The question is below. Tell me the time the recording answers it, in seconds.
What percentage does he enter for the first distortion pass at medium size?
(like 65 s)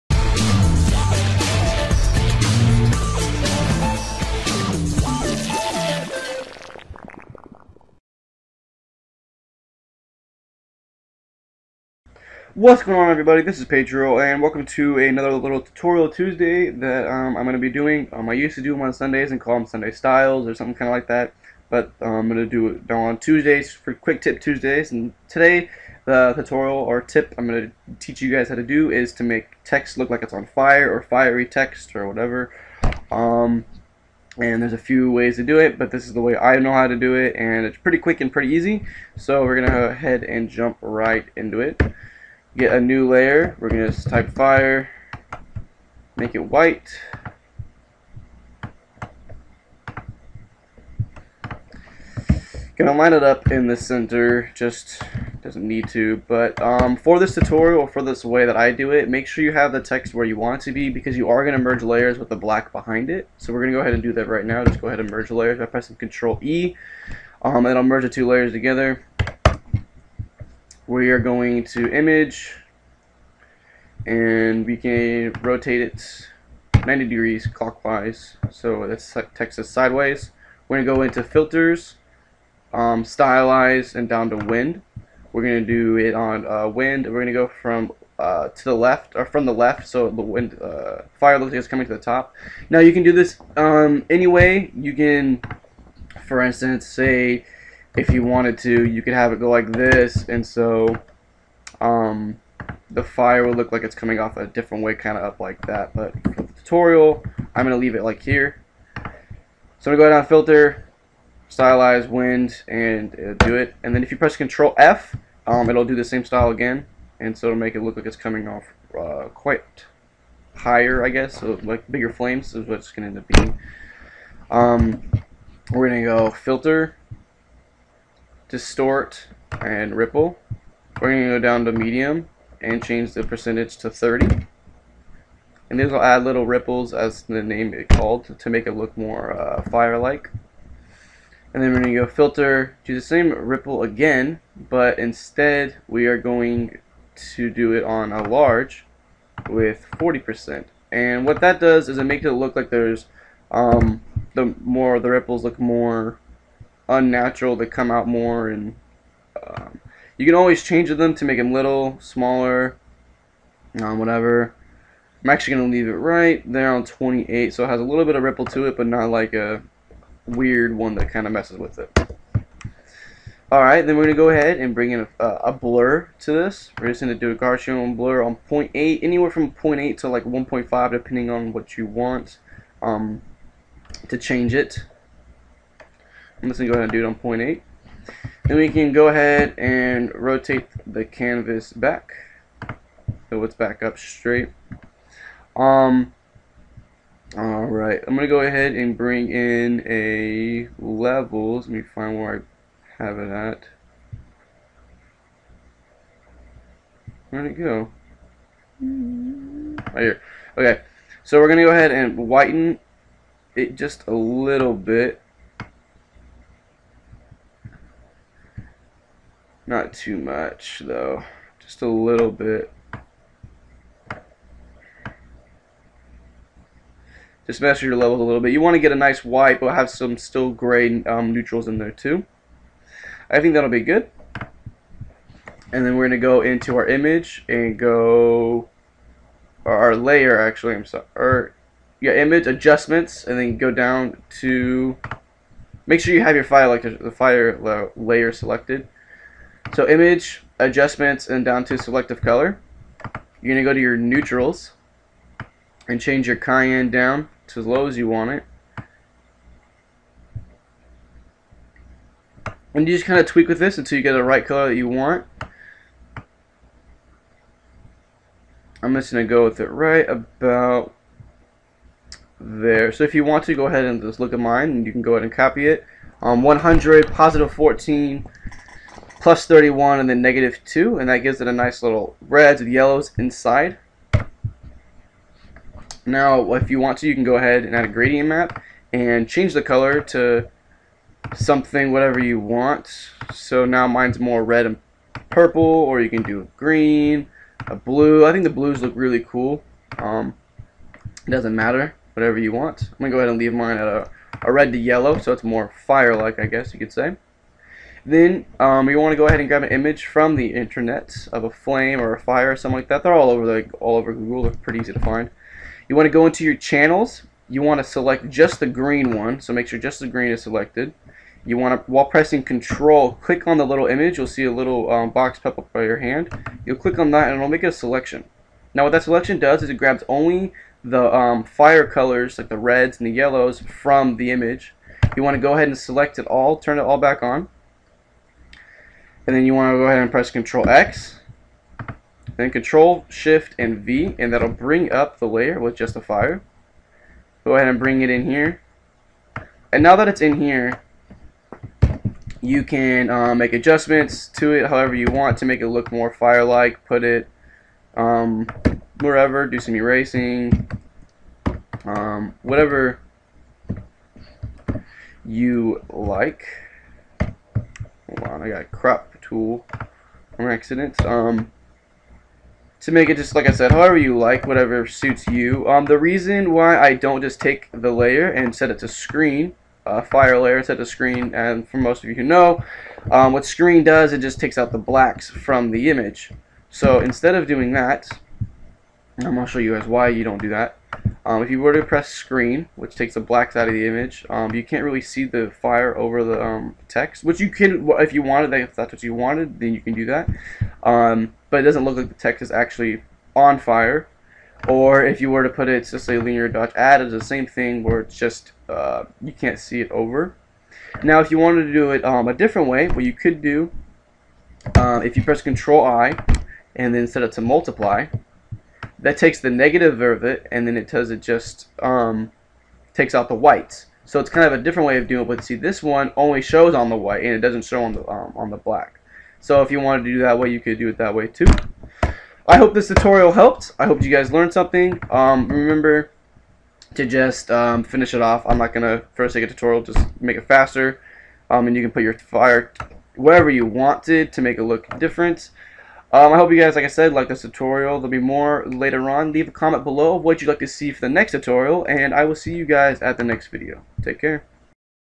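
133 s.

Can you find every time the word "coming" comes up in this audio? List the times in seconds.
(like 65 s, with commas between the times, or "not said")
91 s, 103 s, 118 s.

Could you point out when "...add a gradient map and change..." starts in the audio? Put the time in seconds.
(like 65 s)
287 s.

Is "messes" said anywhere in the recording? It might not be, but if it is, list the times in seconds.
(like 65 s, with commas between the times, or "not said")
171 s.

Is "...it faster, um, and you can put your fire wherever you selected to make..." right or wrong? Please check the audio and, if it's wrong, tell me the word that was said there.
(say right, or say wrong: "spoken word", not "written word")
wrong: "wanted", not "selected".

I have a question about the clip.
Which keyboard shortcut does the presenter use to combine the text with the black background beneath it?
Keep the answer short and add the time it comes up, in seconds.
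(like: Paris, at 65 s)
Control E, at 65 s.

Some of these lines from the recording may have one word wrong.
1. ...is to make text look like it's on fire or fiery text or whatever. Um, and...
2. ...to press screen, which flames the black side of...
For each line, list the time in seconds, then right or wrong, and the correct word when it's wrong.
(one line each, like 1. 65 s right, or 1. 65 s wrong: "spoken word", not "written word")
1. 28 s right
2. 391 s wrong: "takes", not "flames".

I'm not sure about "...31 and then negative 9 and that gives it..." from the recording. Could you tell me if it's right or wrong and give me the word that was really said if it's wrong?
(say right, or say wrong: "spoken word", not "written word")
wrong: "2", not "9".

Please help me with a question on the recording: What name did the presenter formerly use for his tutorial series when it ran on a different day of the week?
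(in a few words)
Sunday Styles.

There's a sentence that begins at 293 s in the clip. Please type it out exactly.
So now mine's more red and purple or you can do green, a blue.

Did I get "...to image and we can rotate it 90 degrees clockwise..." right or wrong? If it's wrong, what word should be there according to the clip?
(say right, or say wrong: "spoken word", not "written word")
right.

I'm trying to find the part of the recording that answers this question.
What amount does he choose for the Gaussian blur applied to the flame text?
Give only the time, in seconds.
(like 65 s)
187 s.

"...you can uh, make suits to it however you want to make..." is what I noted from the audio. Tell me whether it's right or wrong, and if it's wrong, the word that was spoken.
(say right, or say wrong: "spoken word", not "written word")
wrong: "adjustments", not "suits".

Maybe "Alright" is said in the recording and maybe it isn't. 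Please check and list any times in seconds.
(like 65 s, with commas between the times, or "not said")
173 s, 197 s.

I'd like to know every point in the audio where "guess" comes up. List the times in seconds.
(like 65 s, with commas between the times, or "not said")
121 s, 306 s.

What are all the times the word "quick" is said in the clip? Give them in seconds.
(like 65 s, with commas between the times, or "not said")
23 s, 37 s.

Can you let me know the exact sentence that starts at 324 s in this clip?
You'll see a little um, box pop up by your hand.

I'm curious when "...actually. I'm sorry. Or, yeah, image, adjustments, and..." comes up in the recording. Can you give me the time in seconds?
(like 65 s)
240 s.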